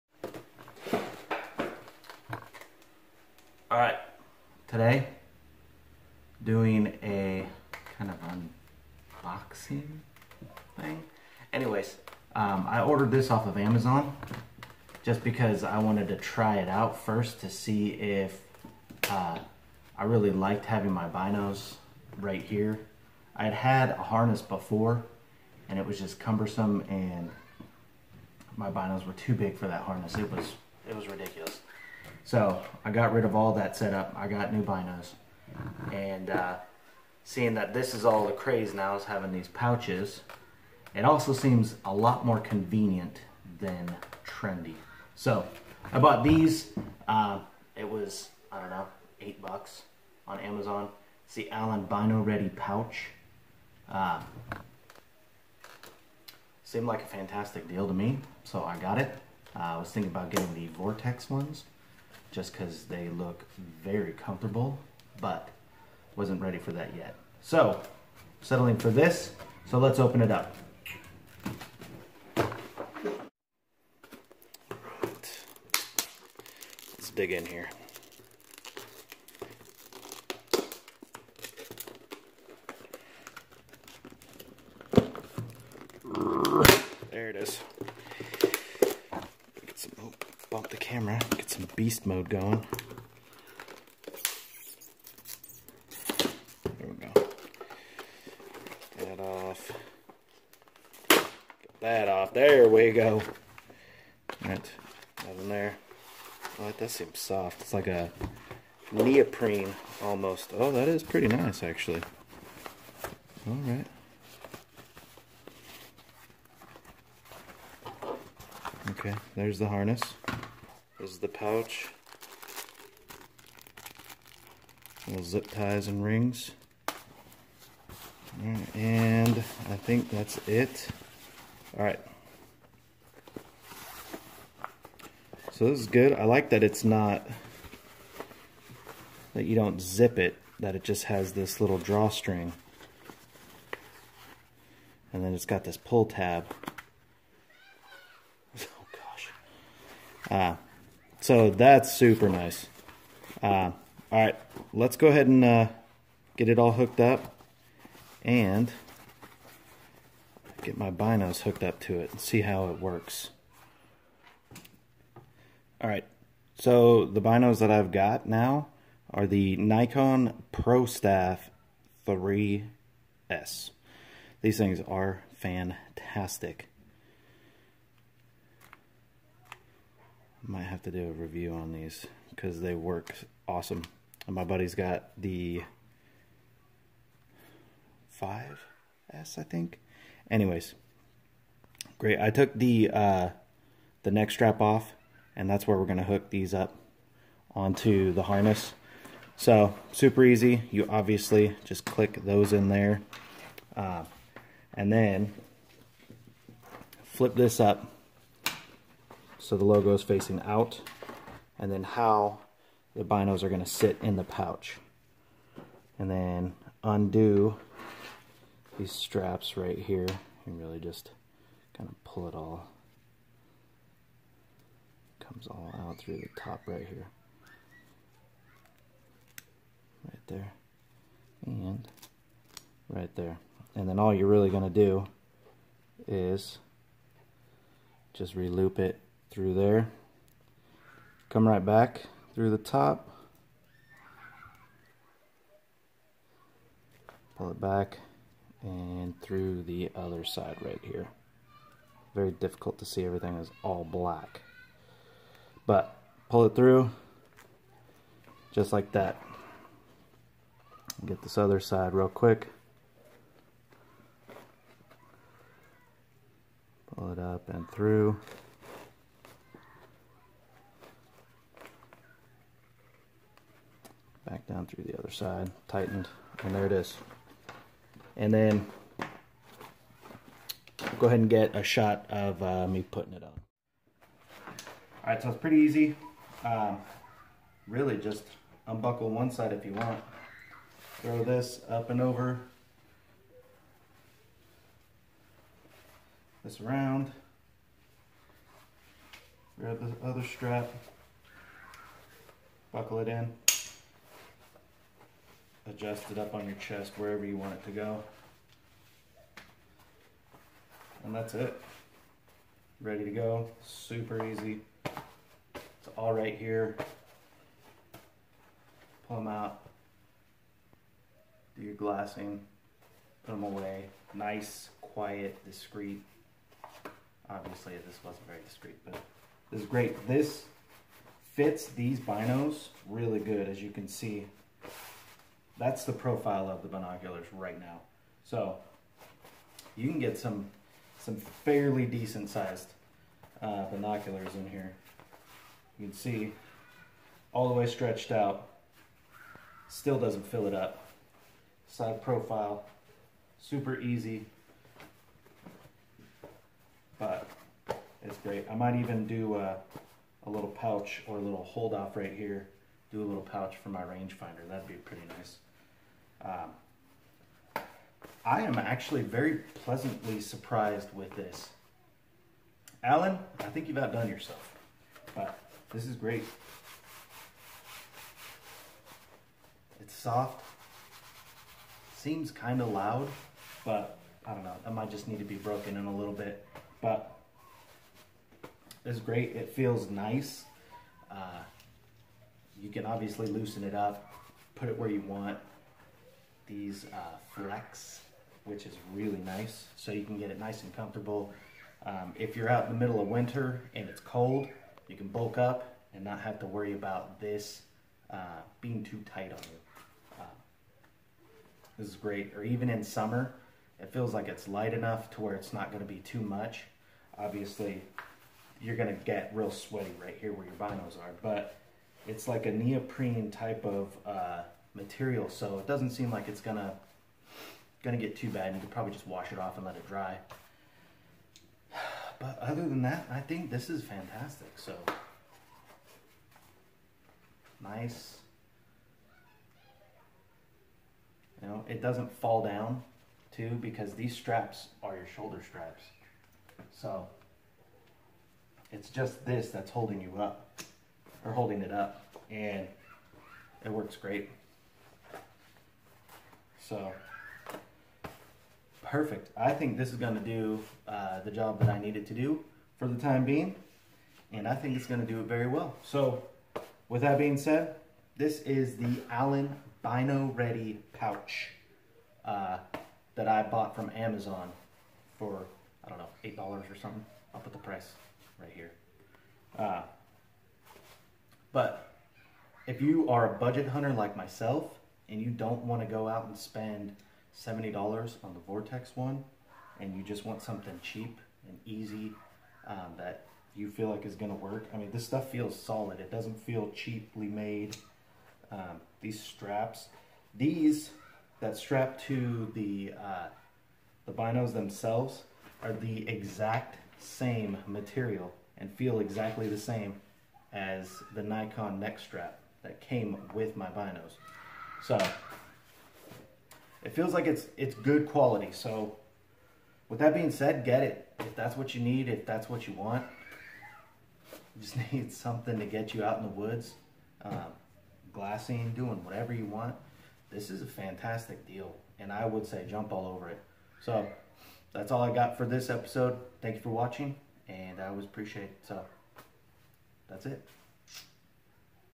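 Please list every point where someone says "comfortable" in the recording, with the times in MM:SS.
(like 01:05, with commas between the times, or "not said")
01:04, 06:40.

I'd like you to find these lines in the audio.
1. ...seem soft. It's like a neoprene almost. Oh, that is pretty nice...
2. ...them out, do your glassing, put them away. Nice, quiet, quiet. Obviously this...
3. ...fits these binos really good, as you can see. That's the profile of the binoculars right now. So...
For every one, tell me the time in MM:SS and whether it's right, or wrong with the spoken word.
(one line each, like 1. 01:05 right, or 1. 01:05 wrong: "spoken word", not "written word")
1. 01:46 right
2. 05:19 wrong: "discreet", not "quiet"
3. 05:31 right.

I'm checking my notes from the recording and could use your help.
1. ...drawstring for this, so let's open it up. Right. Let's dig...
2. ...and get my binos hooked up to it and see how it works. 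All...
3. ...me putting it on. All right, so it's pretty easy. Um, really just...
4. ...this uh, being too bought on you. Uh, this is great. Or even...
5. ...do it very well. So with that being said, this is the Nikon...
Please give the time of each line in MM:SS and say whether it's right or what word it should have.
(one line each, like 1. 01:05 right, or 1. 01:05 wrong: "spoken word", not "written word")
1. 01:08 wrong: "settling", not "drawstring"
2. 02:38 right
3. 04:42 right
4. 06:47 wrong: "tight", not "bought"
5. 07:45 wrong: "Allen", not "Nikon".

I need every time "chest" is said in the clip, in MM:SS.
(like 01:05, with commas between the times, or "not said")
05:06.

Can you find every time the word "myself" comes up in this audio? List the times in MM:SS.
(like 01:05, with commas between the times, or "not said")
08:04.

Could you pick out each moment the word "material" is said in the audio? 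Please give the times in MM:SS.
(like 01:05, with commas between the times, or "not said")
07:04, 08:27.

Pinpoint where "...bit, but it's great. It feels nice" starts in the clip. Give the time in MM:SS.
06:26.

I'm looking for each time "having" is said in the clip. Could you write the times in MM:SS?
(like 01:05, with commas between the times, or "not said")
00:20, 00:39.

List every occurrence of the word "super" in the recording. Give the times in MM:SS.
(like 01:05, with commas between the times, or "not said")
02:31, 03:19, 05:13, 05:53.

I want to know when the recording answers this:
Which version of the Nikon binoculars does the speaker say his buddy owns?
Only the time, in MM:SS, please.
03:08.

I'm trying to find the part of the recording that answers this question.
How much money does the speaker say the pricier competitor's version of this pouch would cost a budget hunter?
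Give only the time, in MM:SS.
08:07.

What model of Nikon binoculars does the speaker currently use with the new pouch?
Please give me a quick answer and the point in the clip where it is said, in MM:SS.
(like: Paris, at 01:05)
ProStaff 3S, at 02:50.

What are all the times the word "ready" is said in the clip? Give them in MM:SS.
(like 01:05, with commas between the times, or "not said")
00:52, 01:06, 05:12, 07:50.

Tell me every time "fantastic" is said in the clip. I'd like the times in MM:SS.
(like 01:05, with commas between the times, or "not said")
00:57, 02:55, 07:13, 08:50.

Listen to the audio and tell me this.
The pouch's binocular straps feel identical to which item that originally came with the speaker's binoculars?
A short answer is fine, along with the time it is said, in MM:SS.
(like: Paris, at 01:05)
Nikon neck strap, at 08:31.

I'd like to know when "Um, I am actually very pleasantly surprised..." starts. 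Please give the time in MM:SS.
06:06.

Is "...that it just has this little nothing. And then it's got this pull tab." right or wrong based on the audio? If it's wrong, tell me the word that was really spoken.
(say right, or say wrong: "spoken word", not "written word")
wrong: "drawstring", not "nothing".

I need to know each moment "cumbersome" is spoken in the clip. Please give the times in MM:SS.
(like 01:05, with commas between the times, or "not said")
00:26.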